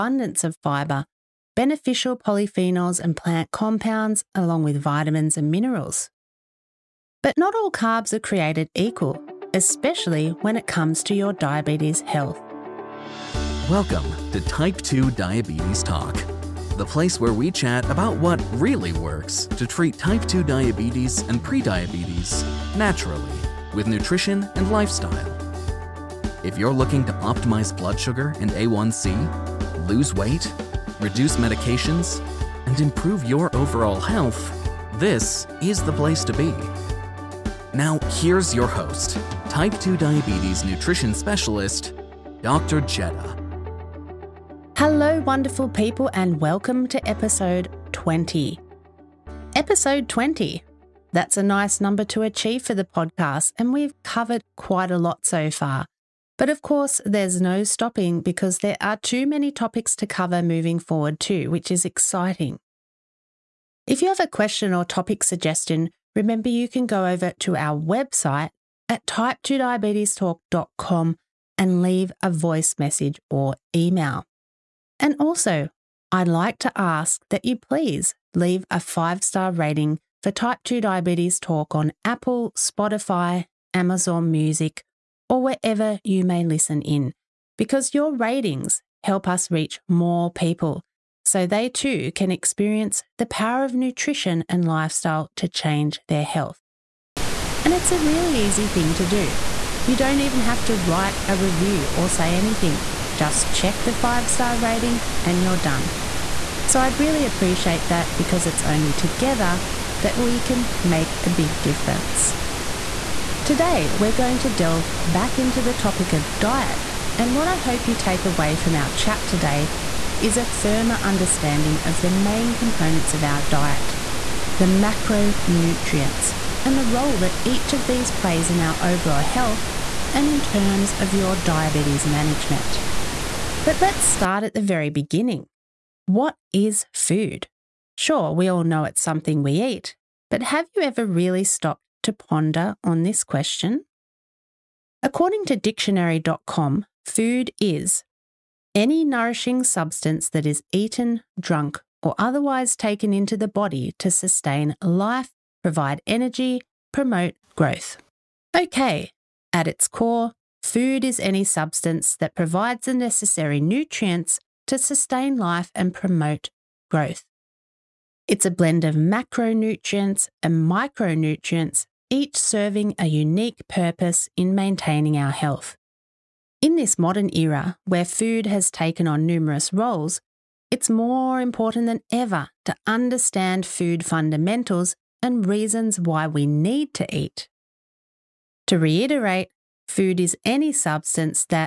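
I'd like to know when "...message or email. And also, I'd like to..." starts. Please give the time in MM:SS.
01:12.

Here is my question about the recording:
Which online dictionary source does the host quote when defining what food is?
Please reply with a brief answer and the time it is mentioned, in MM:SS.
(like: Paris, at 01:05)
dictionary.com, at 02:25.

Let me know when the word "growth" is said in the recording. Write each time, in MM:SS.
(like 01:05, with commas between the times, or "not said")
02:37, 02:46.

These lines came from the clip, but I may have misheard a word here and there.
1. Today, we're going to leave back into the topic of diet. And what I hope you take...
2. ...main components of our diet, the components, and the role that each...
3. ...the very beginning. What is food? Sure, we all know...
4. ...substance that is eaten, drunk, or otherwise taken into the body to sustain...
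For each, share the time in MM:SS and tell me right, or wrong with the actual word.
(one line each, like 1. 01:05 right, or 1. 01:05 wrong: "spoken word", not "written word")
1. 01:53 wrong: "delve", not "leave"
2. 02:02 wrong: "macronutrients", not "components"
3. 02:14 right
4. 02:29 right.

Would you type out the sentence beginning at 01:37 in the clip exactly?
And it's a really easy thing to do.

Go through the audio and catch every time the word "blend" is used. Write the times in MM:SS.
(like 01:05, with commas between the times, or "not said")
02:48.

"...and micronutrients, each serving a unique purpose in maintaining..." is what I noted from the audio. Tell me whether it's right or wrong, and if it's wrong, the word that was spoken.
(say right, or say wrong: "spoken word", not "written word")
right.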